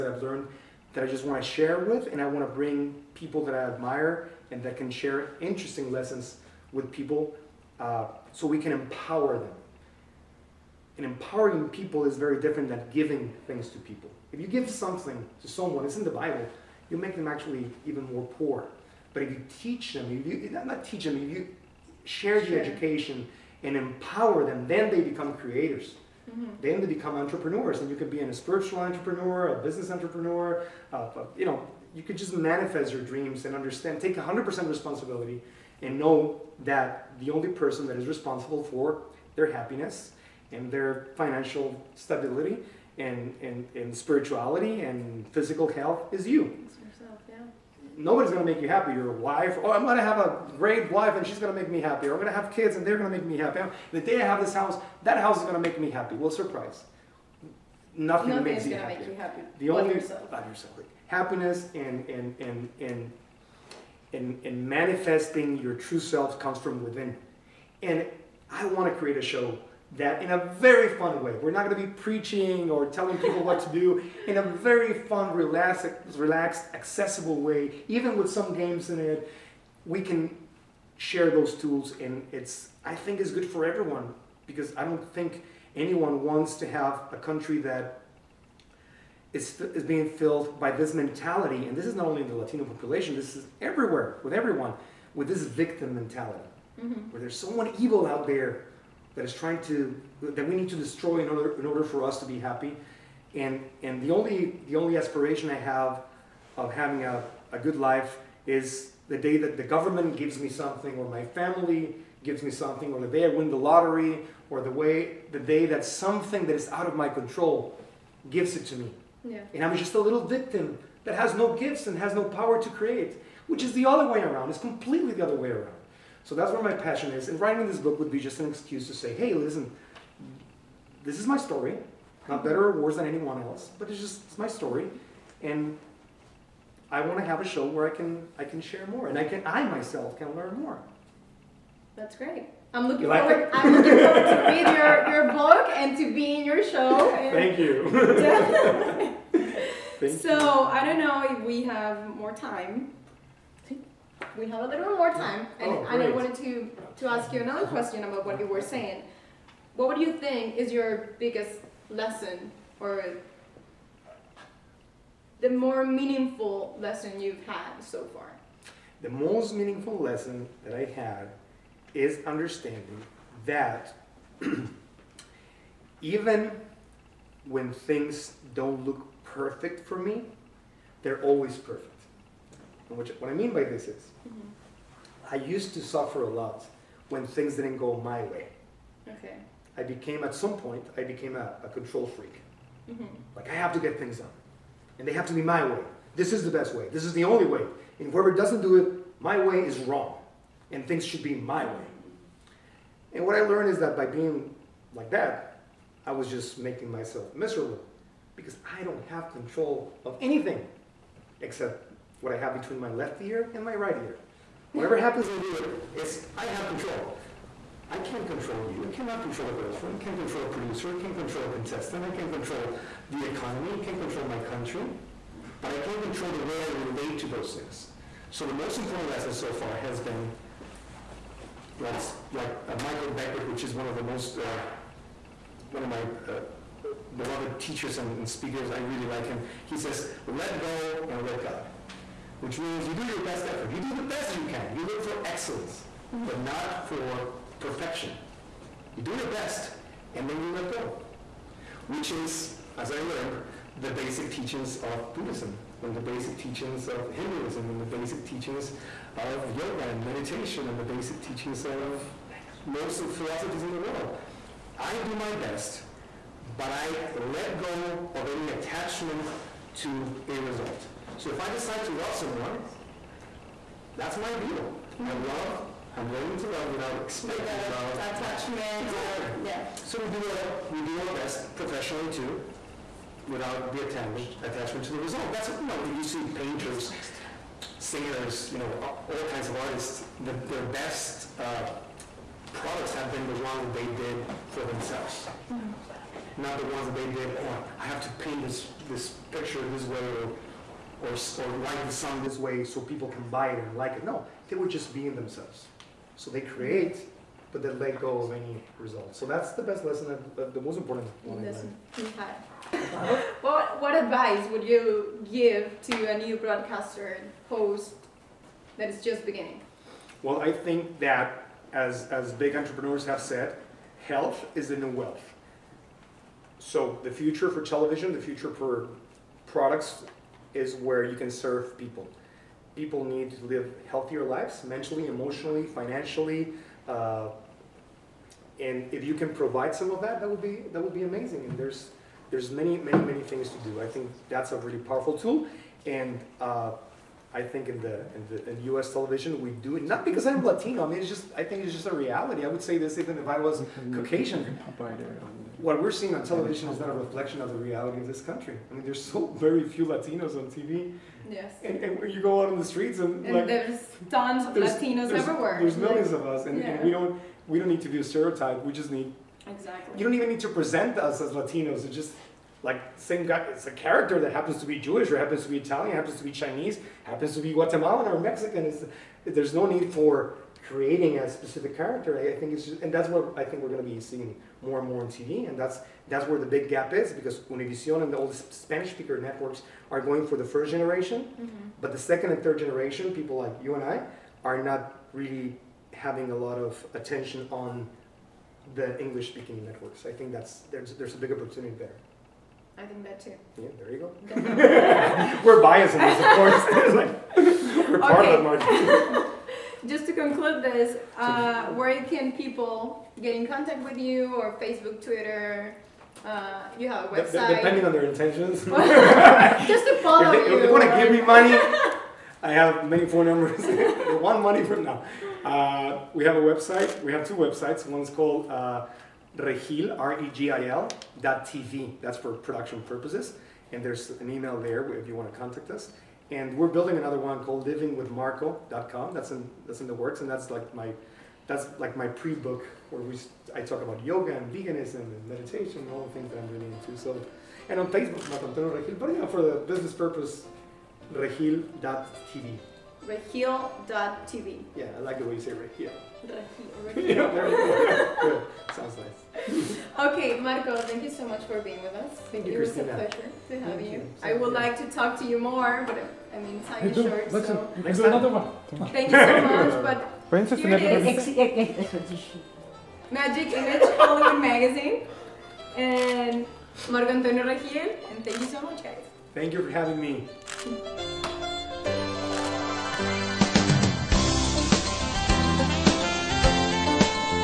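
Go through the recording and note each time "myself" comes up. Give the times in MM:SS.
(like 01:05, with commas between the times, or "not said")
02:19, 03:26.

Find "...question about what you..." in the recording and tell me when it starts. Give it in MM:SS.
02:37.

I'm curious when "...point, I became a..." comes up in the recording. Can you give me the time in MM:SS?
03:10.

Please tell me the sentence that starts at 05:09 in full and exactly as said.
So that's the best lesson, the most important one.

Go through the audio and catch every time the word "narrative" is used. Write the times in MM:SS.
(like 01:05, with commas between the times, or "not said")
not said.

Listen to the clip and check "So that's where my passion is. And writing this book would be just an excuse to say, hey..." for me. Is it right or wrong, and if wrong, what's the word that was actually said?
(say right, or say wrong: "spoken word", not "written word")
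right.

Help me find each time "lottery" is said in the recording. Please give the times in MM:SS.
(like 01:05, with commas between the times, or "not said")
01:53.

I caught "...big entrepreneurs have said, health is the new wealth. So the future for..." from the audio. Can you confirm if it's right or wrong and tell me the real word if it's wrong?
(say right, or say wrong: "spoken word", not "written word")
right.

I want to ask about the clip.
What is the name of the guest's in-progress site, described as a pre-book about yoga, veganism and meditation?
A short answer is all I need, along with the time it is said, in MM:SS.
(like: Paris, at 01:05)
livingwithmarco.com, at 07:17.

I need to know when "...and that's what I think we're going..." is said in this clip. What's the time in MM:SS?
06:22.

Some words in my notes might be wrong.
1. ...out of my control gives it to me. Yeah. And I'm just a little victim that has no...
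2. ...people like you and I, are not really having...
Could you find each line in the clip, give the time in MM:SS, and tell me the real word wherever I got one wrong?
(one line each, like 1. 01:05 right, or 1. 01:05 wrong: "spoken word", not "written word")
1. 01:56 right
2. 06:33 right.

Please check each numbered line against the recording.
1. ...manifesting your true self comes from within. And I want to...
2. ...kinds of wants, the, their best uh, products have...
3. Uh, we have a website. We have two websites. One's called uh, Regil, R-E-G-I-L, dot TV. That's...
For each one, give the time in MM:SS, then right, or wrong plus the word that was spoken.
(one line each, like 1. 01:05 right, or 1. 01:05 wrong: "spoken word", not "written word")
1. 01:04 right
2. 04:49 wrong: "artists", not "wants"
3. 07:05 right.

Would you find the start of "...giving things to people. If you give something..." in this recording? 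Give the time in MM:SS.
00:12.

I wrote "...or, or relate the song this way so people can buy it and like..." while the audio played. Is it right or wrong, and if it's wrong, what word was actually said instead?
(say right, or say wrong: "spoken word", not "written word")
wrong: "write", not "relate".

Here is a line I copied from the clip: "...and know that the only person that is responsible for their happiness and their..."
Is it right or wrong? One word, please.
right.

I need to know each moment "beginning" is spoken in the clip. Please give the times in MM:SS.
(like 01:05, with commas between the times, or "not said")
05:19.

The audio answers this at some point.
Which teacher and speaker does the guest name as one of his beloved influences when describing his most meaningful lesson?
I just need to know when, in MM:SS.
03:52.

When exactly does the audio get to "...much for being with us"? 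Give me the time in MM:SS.
07:41.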